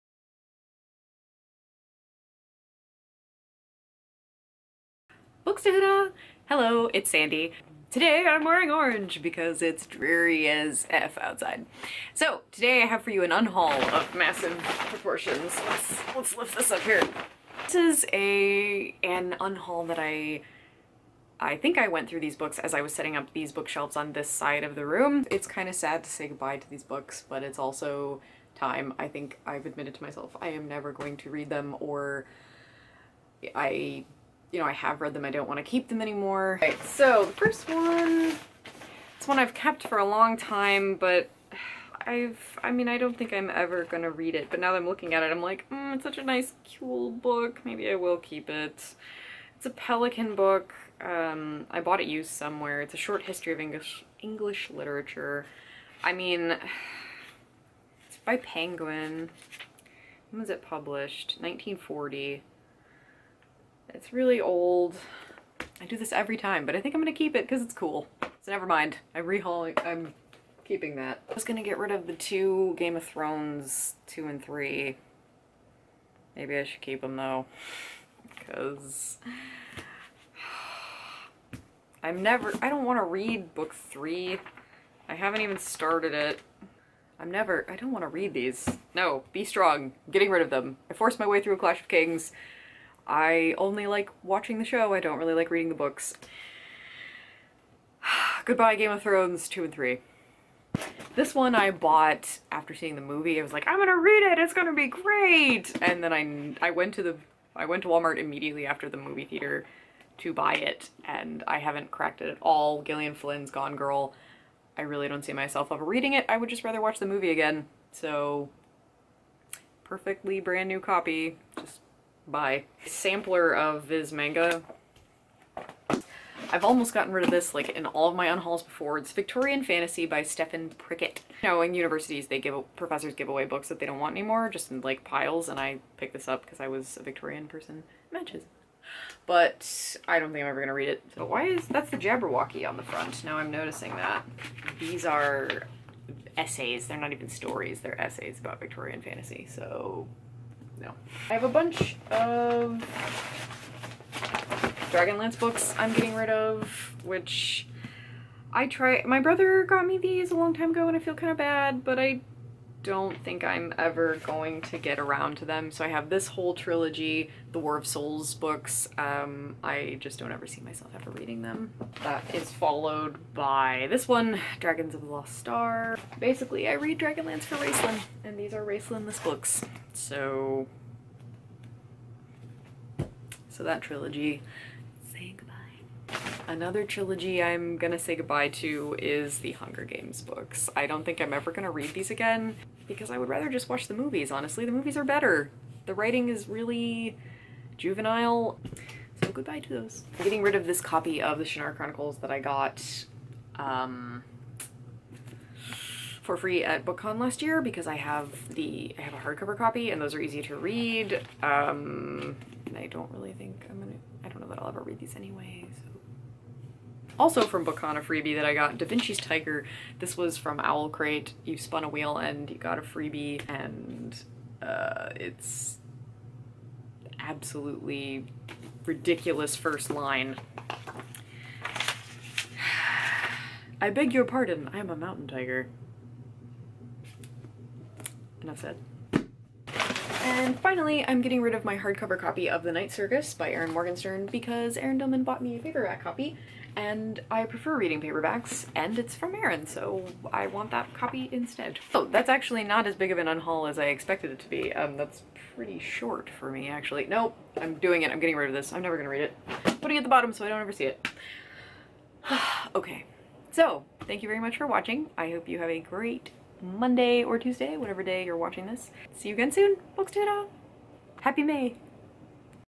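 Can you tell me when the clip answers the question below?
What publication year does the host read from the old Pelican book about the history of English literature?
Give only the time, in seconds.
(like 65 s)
61 s.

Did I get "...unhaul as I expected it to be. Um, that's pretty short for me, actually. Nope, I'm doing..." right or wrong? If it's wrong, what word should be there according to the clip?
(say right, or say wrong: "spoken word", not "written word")
right.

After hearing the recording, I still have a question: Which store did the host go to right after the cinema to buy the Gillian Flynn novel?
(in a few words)
Walmart.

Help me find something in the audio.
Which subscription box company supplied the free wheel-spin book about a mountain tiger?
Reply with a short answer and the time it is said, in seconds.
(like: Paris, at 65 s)
Owl Crate, at 220 s.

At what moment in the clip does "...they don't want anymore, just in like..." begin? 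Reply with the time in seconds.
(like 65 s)
133 s.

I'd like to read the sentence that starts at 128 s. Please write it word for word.
It's Victorian Fantasy by Stephen Prickett.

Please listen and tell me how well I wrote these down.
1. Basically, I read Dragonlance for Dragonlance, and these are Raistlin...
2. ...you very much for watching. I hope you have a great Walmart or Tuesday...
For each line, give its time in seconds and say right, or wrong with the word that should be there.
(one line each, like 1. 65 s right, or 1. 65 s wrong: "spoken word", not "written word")
1. 176 s wrong: "Raistlin", not "Dragonlance"
2. 264 s wrong: "Monday", not "Walmart".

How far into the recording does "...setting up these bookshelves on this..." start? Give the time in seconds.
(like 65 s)
22 s.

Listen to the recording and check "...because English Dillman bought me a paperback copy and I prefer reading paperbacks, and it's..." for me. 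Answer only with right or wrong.
wrong.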